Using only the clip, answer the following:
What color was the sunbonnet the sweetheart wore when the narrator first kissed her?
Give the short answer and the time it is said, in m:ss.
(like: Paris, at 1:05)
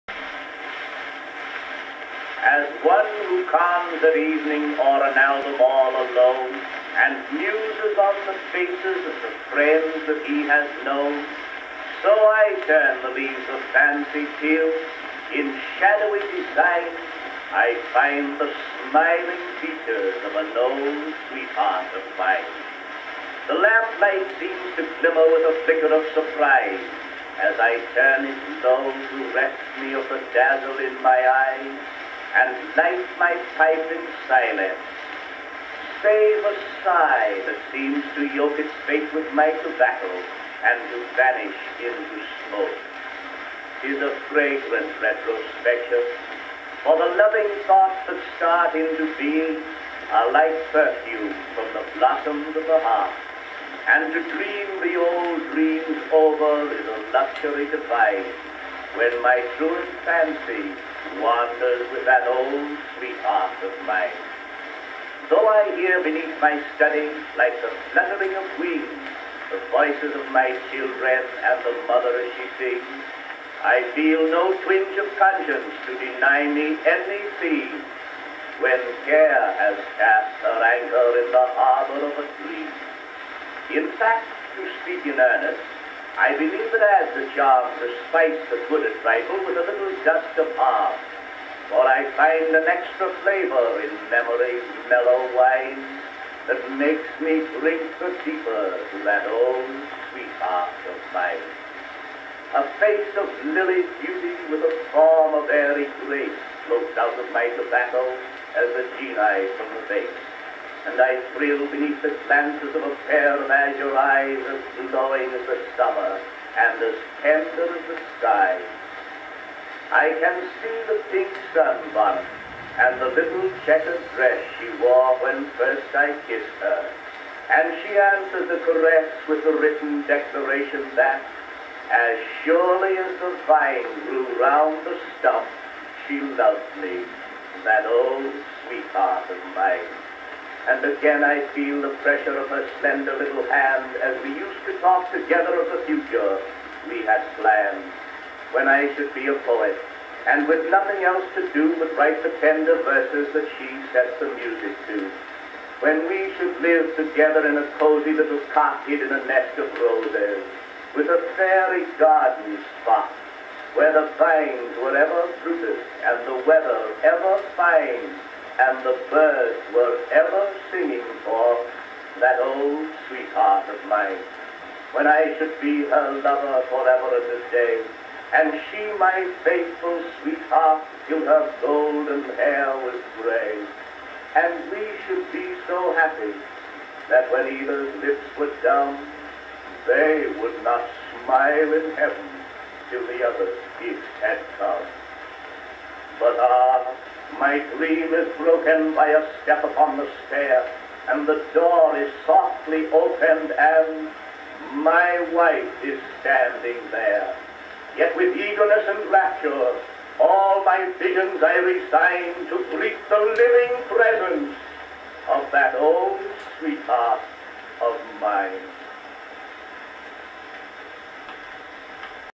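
pink, at 2:01.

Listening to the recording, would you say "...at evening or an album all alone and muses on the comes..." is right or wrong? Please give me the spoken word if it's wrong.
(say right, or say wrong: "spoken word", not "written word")
wrong: "faces", not "comes".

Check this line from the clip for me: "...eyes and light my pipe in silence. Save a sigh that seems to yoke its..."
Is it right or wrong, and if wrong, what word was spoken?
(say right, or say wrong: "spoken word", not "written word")
right.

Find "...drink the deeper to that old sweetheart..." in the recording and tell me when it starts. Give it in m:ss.
1:37.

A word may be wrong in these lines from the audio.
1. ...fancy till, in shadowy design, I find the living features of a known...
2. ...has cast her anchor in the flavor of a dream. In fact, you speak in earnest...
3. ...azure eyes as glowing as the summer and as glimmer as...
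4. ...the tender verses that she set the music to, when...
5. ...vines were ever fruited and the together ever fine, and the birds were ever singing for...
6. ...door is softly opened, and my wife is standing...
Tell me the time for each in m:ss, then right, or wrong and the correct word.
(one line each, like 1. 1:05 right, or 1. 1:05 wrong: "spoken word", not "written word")
1. 0:13 wrong: "smiling", not "living"
2. 1:19 wrong: "harbor", not "flavor"
3. 1:53 wrong: "tender", not "glimmer"
4. 2:32 right
5. 2:44 wrong: "weather", not "together"
6. 3:21 right.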